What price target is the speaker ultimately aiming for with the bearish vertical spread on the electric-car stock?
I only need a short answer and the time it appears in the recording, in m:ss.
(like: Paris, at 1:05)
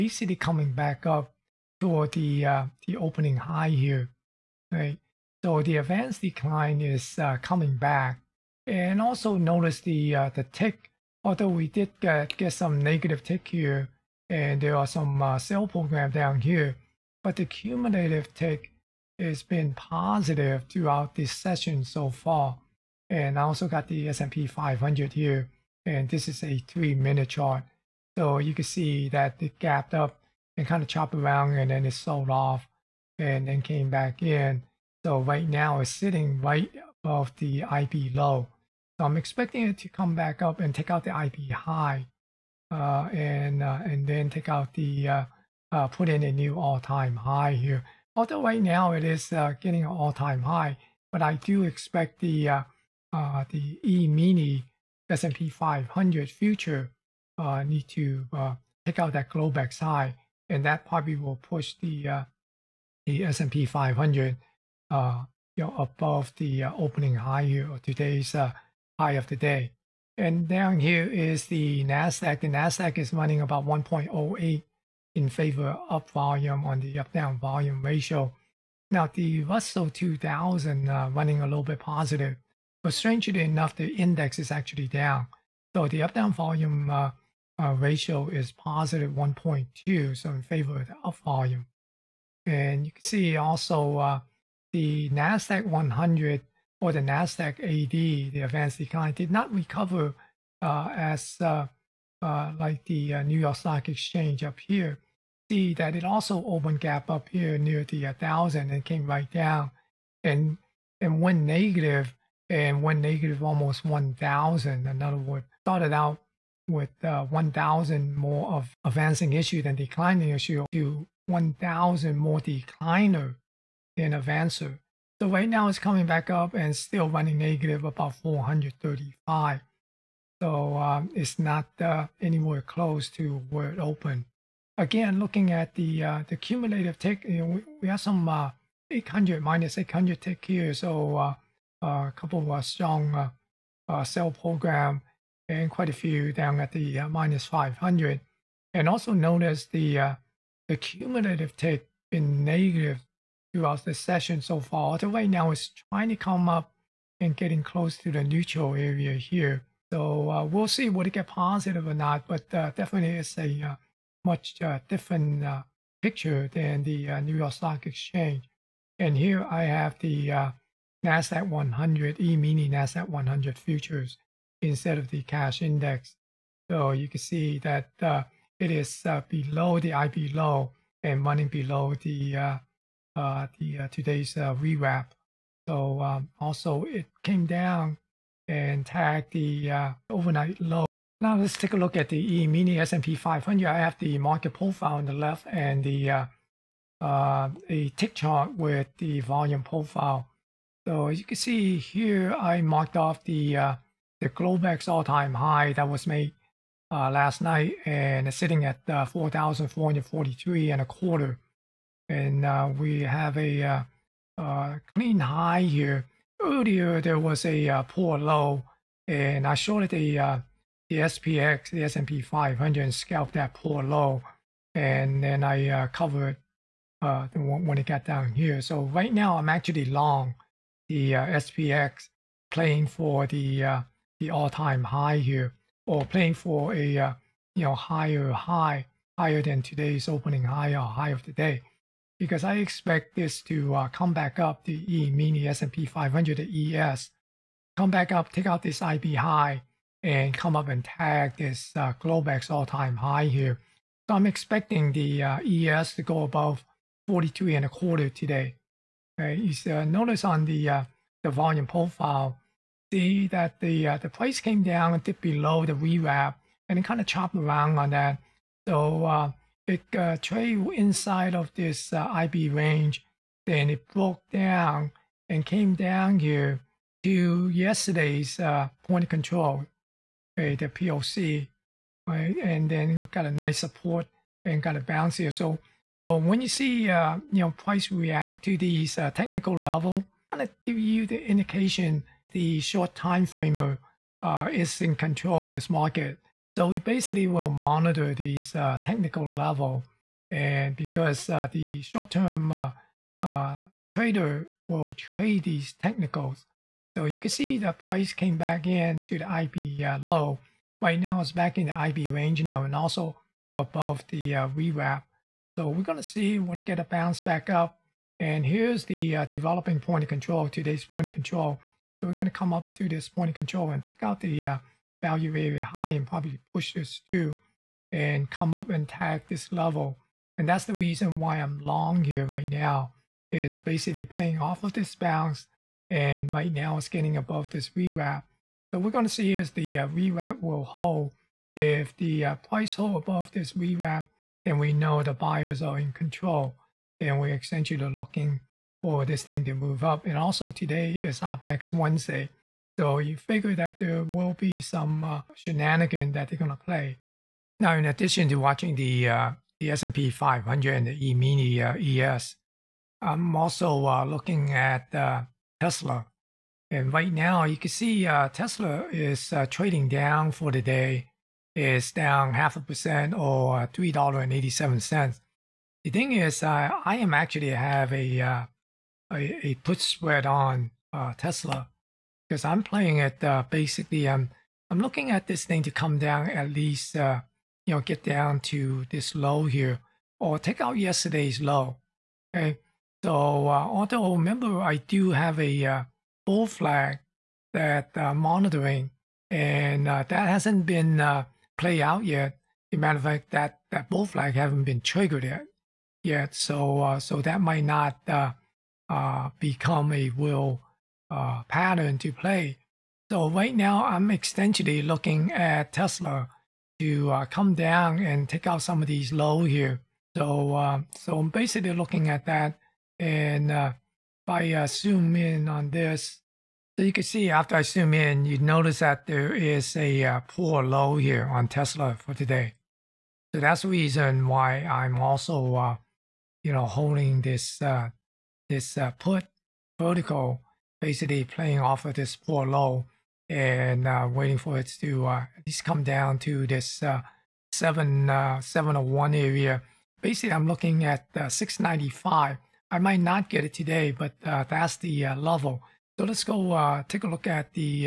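695, at 7:31.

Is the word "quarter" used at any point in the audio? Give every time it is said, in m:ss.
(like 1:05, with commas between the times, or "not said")
3:30, 4:17.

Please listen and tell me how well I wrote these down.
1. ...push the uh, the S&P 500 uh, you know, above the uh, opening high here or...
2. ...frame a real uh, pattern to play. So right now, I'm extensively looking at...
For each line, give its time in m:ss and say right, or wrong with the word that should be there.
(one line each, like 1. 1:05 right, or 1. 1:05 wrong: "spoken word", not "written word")
1. 1:01 right
2. 6:49 wrong: "become", not "frame".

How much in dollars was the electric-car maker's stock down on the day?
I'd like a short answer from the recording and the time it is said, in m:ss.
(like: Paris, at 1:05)
$3.87, at 6:13.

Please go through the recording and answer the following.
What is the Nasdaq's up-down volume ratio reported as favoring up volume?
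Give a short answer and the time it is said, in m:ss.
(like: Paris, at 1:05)
1.08, at 1:13.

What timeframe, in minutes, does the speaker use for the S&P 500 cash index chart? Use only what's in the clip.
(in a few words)
3 minutes.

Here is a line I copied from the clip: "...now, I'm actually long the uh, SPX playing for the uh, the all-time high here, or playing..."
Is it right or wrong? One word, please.
right.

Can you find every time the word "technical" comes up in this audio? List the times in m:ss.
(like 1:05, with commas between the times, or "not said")
4:49, 4:58, 5:05.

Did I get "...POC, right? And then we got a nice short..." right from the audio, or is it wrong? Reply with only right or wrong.
wrong.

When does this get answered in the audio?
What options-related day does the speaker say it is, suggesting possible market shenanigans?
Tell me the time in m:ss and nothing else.
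5:51.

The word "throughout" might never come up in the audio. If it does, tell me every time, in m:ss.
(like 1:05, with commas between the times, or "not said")
0:20, 2:33.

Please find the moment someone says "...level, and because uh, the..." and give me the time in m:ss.
4:59.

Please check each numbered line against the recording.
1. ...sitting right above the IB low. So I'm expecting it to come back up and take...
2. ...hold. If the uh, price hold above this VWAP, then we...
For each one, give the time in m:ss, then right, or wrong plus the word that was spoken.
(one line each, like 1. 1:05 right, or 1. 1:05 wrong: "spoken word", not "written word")
1. 0:35 right
2. 5:40 right.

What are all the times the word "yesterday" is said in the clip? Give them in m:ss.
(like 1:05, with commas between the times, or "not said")
4:37, 6:30.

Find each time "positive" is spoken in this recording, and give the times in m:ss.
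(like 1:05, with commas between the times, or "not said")
0:19, 1:21, 1:28, 2:41.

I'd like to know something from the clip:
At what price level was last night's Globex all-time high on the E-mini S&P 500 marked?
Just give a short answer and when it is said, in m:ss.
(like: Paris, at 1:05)
4,443.25, at 3:29.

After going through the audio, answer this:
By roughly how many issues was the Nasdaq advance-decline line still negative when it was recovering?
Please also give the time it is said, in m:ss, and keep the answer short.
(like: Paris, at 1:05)
435, at 2:08.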